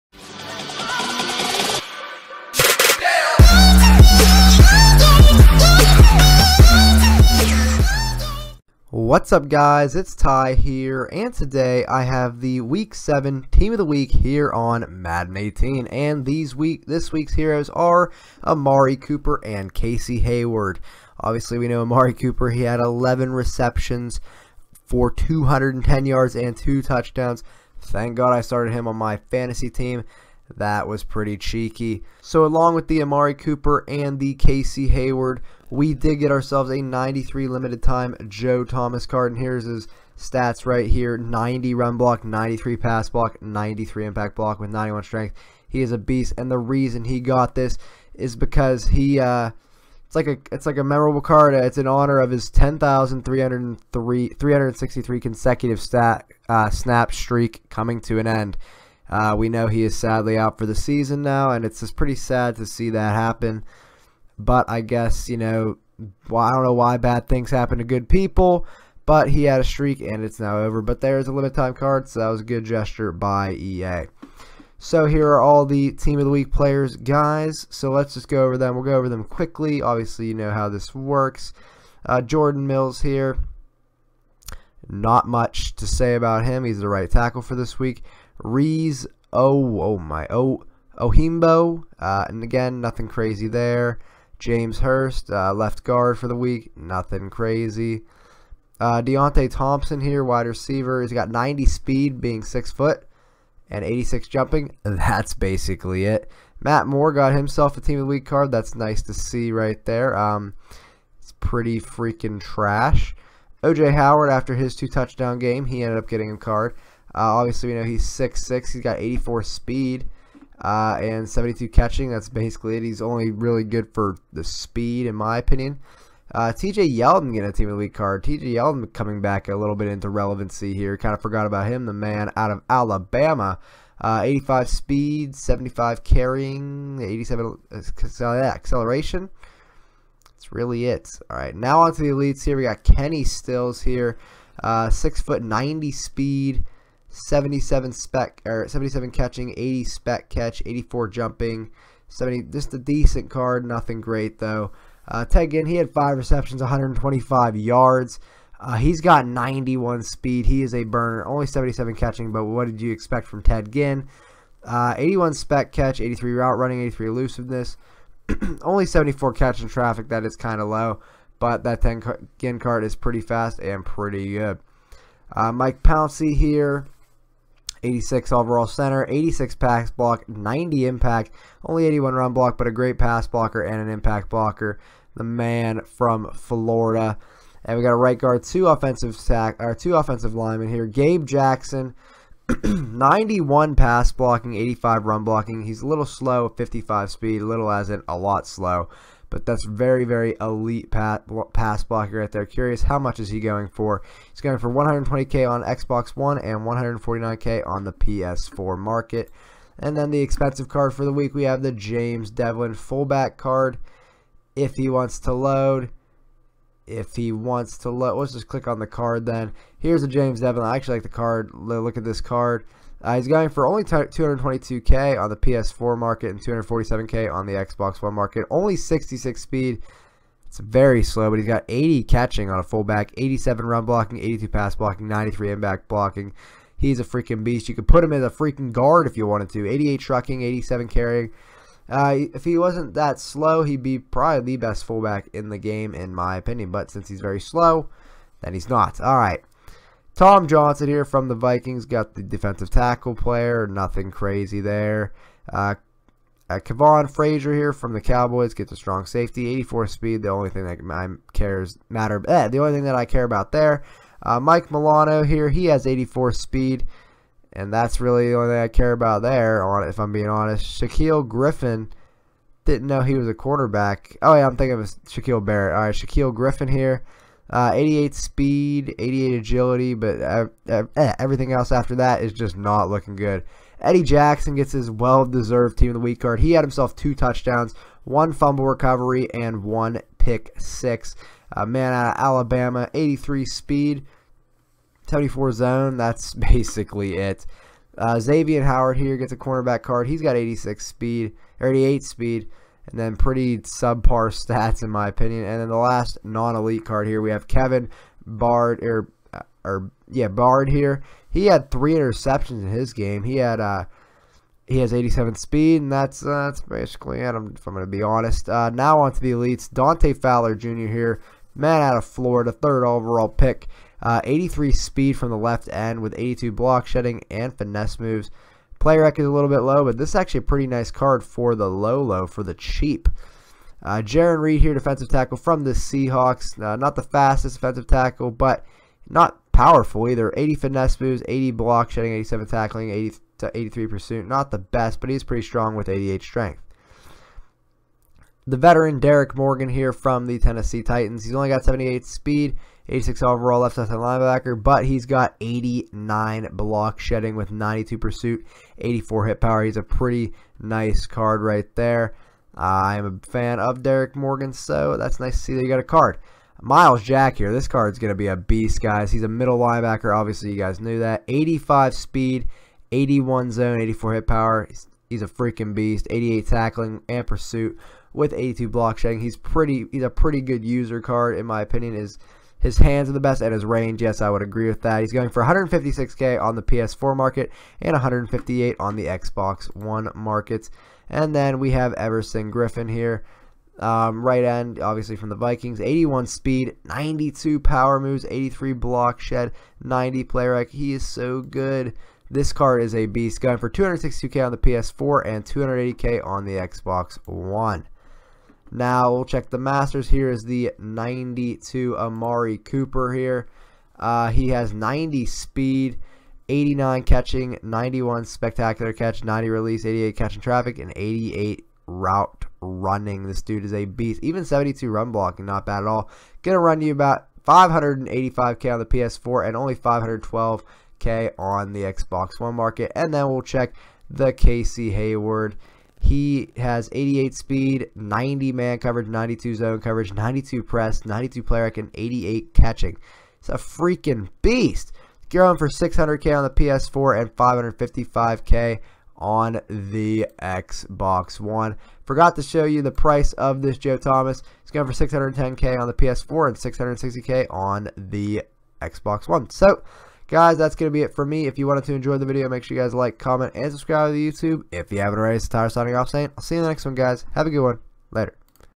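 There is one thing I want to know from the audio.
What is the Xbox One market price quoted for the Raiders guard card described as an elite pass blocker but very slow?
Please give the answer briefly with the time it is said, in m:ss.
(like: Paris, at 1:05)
120K, at 3:24.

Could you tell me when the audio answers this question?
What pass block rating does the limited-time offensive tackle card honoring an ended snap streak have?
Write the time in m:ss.
0:42.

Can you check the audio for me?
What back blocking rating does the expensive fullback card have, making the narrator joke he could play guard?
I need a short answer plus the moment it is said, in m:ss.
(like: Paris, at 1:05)
93, at 3:55.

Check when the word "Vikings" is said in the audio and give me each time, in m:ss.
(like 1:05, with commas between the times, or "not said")
4:11, 6:35.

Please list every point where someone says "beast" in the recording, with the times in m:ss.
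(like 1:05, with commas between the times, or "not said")
0:45, 3:57, 6:08, 6:15, 6:43, 7:03, 7:24.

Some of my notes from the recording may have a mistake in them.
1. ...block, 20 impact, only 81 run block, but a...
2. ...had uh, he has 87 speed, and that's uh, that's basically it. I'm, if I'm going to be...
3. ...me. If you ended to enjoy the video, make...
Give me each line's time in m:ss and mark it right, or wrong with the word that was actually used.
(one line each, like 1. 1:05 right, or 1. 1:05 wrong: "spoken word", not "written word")
1. 2:59 wrong: "90", not "20"
2. 5:13 right
3. 7:41 wrong: "wanted", not "ended".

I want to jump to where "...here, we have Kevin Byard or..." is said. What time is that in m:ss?
5:07.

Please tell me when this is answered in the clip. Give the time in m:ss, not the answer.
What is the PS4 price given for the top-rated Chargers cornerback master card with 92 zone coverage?
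7:25.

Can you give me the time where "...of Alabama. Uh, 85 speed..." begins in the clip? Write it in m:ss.
2:12.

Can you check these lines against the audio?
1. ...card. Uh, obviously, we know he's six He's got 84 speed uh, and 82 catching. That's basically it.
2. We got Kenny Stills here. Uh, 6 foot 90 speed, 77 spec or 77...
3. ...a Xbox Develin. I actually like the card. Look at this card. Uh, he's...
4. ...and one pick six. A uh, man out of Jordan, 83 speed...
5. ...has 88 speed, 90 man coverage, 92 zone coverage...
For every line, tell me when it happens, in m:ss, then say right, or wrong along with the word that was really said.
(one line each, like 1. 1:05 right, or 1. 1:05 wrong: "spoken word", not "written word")
1. 1:56 wrong: "72", not "82"
2. 2:22 right
3. 3:40 wrong: "James", not "Xbox"
4. 4:49 wrong: "Alabama", not "Jordan"
5. 7:16 right.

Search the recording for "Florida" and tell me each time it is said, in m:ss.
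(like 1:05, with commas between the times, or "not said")
3:06, 5:22.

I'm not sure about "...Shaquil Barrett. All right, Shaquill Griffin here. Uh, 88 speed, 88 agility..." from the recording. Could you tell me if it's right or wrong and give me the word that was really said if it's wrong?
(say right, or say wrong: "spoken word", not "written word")
right.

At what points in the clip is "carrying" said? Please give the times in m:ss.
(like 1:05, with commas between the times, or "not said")
2:16, 4:00.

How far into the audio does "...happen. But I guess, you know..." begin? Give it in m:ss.
1:03.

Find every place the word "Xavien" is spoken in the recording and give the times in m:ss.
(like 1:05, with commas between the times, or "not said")
4:58.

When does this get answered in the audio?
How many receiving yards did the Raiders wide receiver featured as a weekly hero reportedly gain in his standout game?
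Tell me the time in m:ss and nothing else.
0:25.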